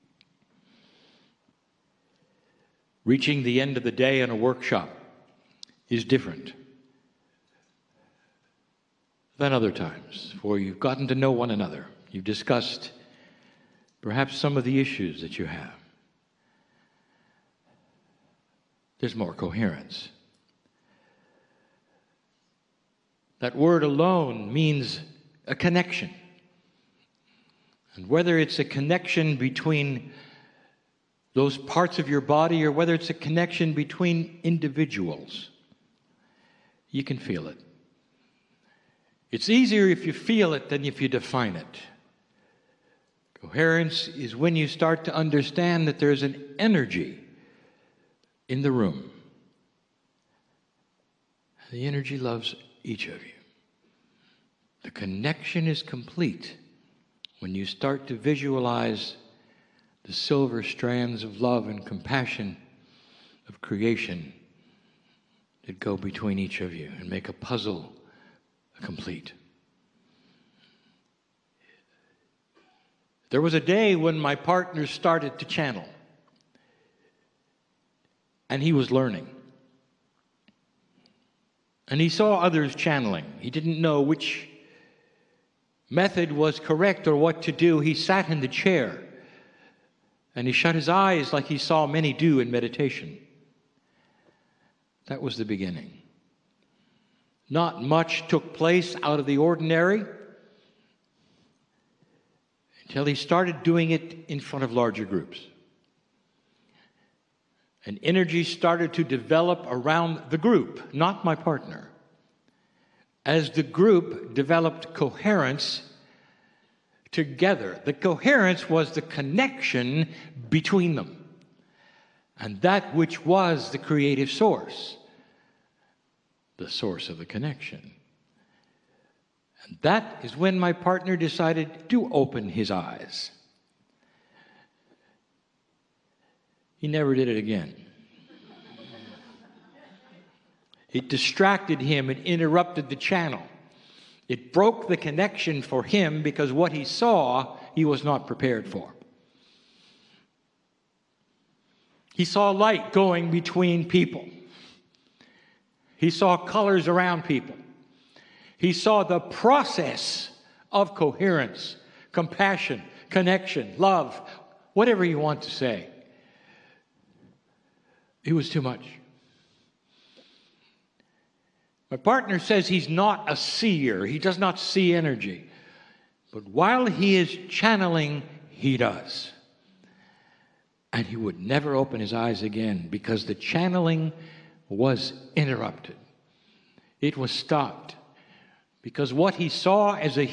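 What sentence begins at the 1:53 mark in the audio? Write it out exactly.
As the group developed coherence together, the coherence was the connection between them.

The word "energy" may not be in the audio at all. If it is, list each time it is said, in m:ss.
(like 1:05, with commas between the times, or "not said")
0:46, 0:51, 1:48, 2:54.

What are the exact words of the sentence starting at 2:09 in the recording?
And that is when my partner decided to open his eyes.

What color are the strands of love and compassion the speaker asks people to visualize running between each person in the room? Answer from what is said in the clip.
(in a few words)
Silver.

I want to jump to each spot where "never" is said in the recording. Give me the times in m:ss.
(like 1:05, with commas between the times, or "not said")
2:16, 3:01.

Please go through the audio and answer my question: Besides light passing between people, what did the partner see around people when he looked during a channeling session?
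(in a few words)
Colors.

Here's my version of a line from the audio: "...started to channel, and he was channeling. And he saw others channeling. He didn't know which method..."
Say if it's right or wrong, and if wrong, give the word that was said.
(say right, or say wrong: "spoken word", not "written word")
wrong: "learning", not "channeling".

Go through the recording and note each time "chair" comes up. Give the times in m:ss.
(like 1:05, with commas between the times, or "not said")
1:28.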